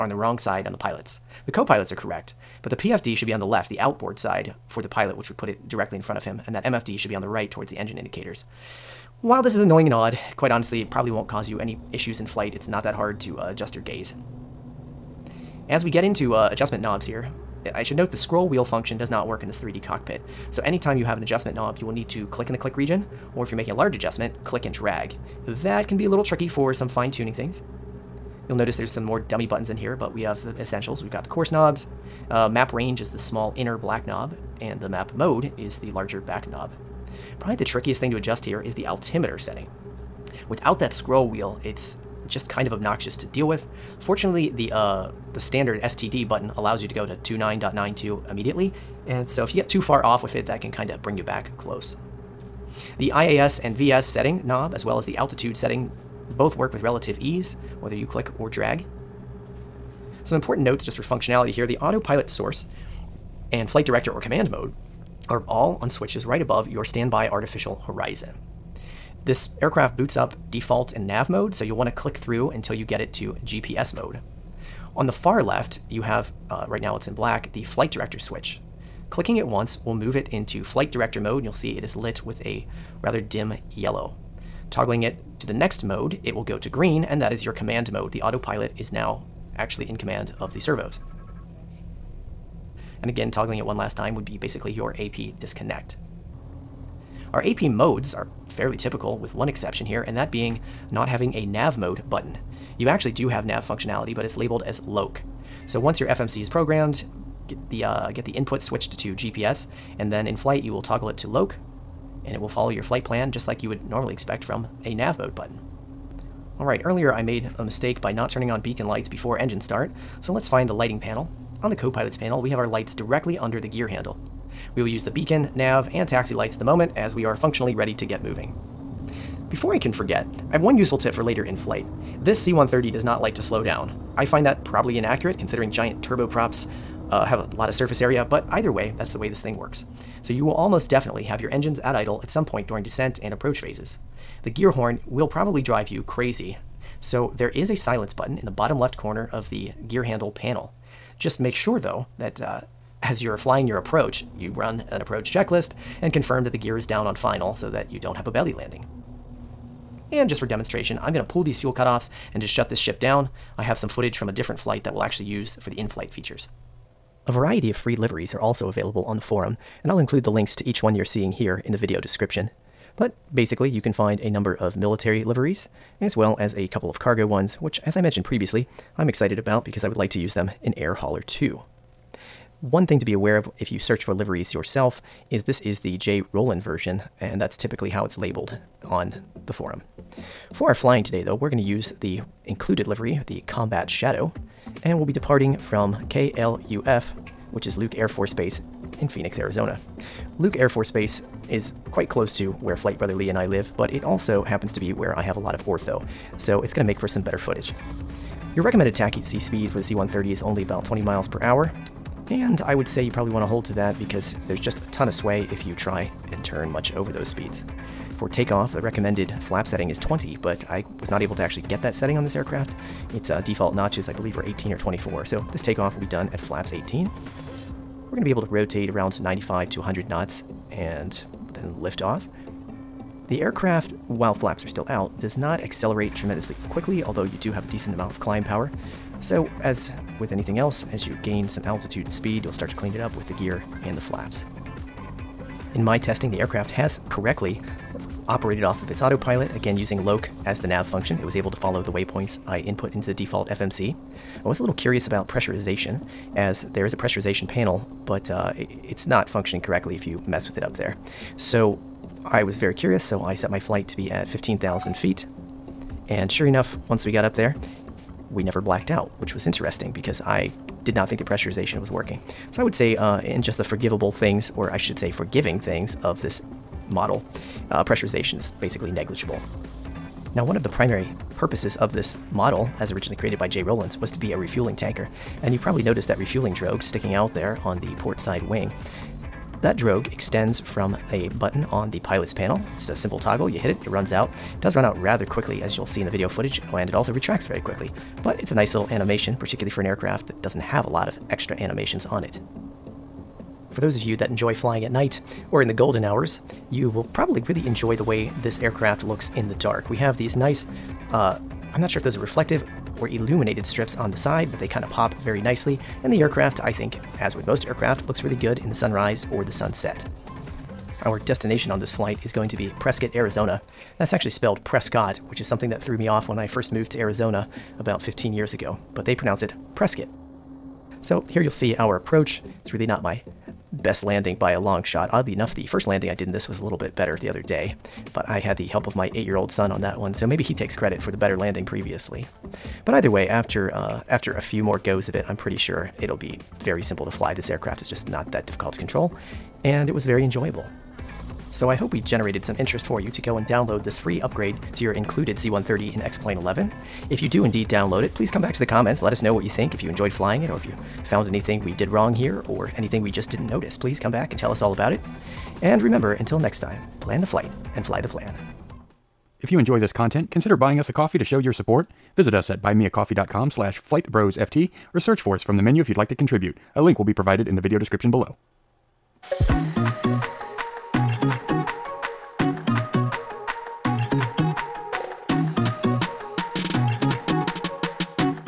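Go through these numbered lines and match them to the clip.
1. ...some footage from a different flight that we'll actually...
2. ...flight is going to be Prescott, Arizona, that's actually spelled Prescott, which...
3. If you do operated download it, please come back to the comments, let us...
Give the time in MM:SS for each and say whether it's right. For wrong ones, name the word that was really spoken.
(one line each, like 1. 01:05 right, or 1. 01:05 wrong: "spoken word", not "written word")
1. 02:43 right
2. 05:21 right
3. 05:57 wrong: "indeed", not "operated".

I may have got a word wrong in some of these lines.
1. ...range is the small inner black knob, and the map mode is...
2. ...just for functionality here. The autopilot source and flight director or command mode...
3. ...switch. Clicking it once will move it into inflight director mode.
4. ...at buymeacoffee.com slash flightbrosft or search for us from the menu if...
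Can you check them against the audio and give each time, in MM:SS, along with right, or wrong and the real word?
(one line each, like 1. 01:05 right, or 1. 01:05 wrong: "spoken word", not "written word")
1. 00:32 right
2. 01:00 right
3. 01:18 wrong: "flight", not "inflight"
4. 06:12 right.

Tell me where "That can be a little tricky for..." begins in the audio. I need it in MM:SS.
00:25.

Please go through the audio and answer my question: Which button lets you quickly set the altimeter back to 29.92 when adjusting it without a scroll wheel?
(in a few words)
STD.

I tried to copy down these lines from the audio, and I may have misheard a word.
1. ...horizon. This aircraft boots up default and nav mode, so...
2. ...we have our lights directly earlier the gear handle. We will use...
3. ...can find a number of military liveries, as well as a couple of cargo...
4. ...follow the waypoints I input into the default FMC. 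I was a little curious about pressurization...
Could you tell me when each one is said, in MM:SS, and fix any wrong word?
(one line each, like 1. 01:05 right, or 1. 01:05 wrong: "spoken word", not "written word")
1. 01:07 right
2. 02:02 wrong: "under", not "earlier"
3. 02:53 right
4. 04:11 right.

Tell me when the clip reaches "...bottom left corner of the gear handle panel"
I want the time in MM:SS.
02:28.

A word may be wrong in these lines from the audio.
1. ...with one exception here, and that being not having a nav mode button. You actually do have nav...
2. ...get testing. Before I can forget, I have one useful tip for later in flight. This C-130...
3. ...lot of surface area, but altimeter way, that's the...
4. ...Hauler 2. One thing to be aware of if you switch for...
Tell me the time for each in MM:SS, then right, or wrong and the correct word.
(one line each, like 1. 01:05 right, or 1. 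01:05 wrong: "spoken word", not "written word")
1. 01:39 right
2. 02:08 wrong: "moving", not "testing"
3. 02:17 wrong: "either", not "altimeter"
4. 03:00 wrong: "search", not "switch".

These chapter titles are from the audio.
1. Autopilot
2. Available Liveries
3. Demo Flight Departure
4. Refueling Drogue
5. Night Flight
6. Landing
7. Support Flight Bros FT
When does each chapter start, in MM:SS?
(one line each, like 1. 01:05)
1. 00:59
2. 02:46
3. 03:08
4. 04:40
5. 05:03
6. 05:21
7. 06:05.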